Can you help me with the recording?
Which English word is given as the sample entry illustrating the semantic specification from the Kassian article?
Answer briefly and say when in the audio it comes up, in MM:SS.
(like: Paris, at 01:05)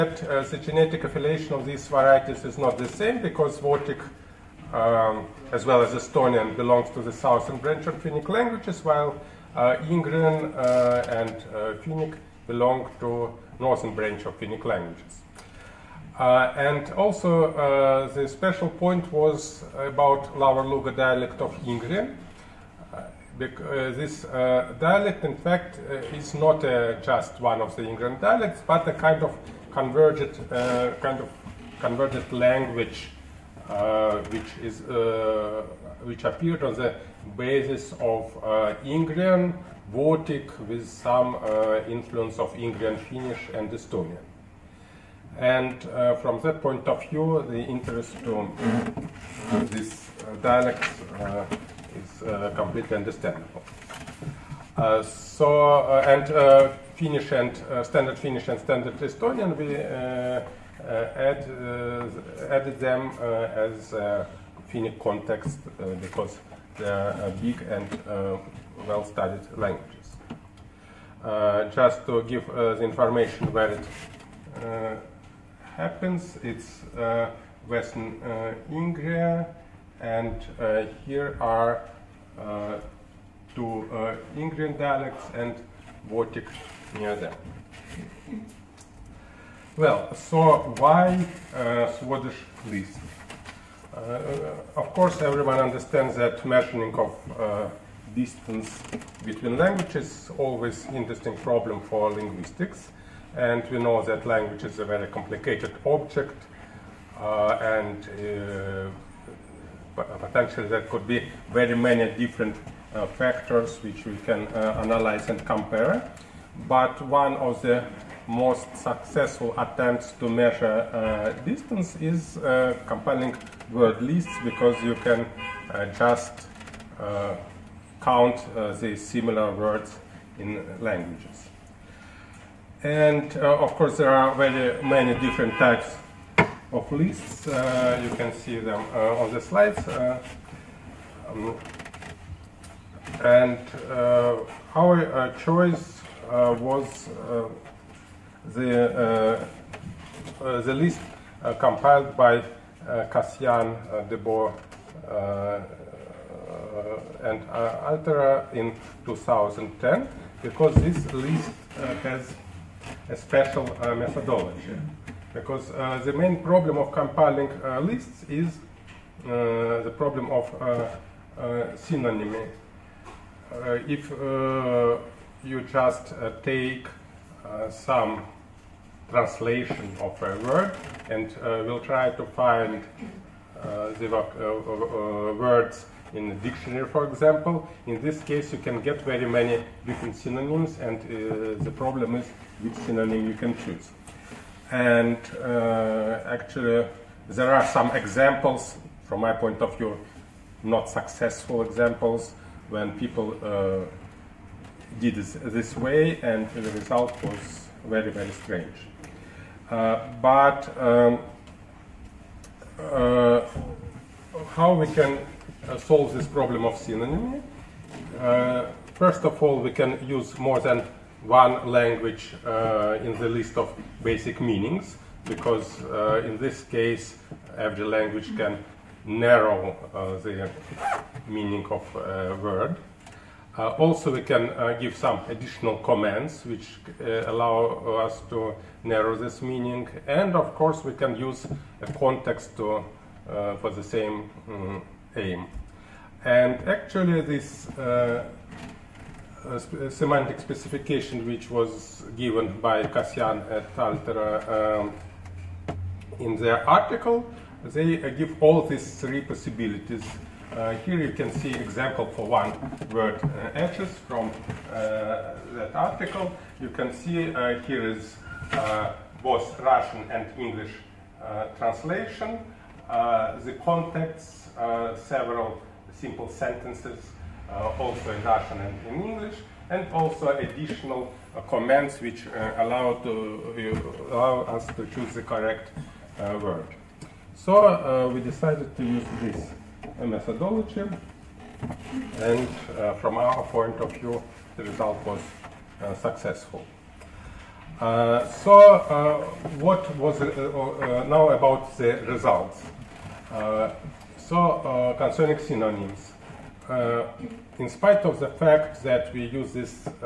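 edges, at 04:23.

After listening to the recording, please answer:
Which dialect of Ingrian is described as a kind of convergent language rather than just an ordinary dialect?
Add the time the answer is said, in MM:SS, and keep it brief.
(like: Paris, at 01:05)
Lower Luga dialect, at 00:20.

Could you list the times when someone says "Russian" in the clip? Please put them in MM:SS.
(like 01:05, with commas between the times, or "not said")
04:29, 04:38.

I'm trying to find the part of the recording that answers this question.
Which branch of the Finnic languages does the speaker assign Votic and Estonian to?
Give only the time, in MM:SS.
00:07.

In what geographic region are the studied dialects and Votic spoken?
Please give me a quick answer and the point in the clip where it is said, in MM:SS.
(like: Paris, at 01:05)
Western Ingria, at 01:17.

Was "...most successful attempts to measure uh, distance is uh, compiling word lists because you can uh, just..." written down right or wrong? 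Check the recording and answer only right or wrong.
right.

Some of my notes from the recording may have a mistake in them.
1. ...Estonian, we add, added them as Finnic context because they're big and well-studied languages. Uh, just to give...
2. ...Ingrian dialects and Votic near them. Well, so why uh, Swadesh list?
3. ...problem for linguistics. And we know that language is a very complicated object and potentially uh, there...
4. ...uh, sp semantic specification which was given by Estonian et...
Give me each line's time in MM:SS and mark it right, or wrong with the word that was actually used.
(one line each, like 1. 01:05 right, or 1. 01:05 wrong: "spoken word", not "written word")
1. 00:58 right
2. 01:24 right
3. 01:41 right
4. 04:07 wrong: "Kassian", not "Estonian".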